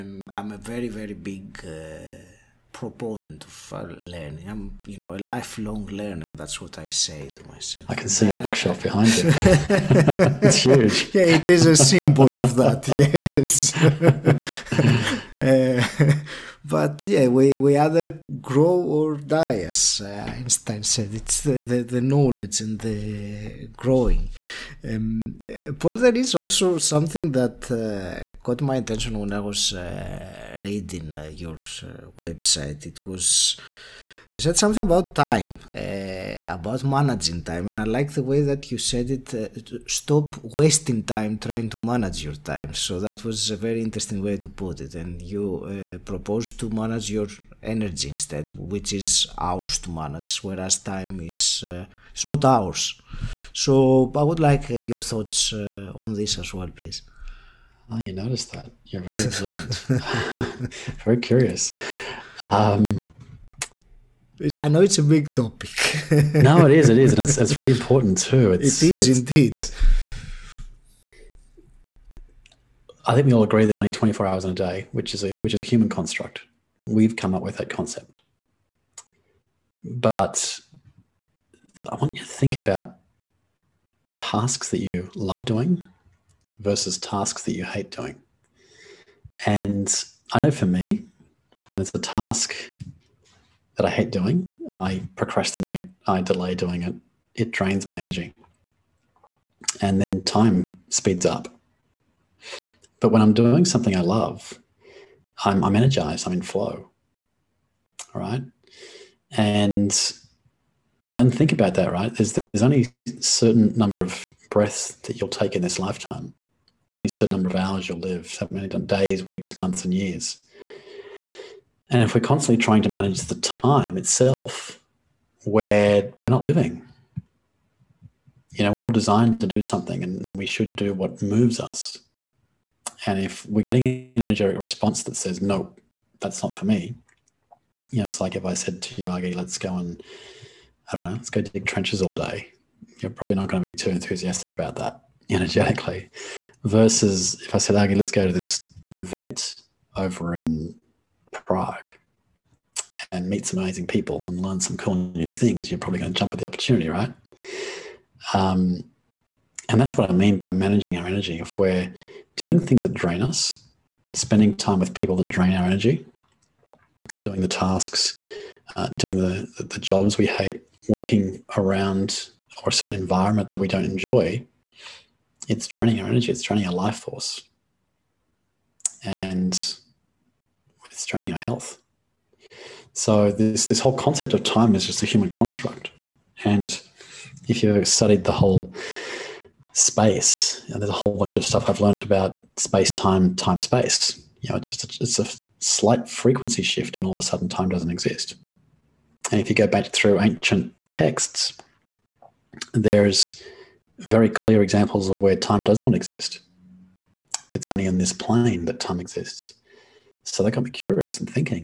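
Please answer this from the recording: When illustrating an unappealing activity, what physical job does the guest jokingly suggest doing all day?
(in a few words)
Dig trenches.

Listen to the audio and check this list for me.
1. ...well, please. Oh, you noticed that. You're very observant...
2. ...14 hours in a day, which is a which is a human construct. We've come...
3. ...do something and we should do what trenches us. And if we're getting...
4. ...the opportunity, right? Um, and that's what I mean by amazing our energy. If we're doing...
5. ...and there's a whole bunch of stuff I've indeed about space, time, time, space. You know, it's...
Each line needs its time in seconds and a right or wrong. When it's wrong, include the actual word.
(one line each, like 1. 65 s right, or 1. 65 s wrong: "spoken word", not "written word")
1. 56 s right
2. 73 s wrong: "24", not "14"
3. 129 s wrong: "moves", not "trenches"
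4. 156 s wrong: "managing", not "amazing"
5. 190 s wrong: "learned", not "indeed".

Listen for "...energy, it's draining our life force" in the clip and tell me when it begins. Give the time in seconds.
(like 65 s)
176 s.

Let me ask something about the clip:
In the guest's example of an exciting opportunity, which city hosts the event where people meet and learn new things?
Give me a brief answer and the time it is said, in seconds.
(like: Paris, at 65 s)
Prague, at 151 s.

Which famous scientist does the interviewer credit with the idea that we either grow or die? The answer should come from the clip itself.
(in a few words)
Einstein.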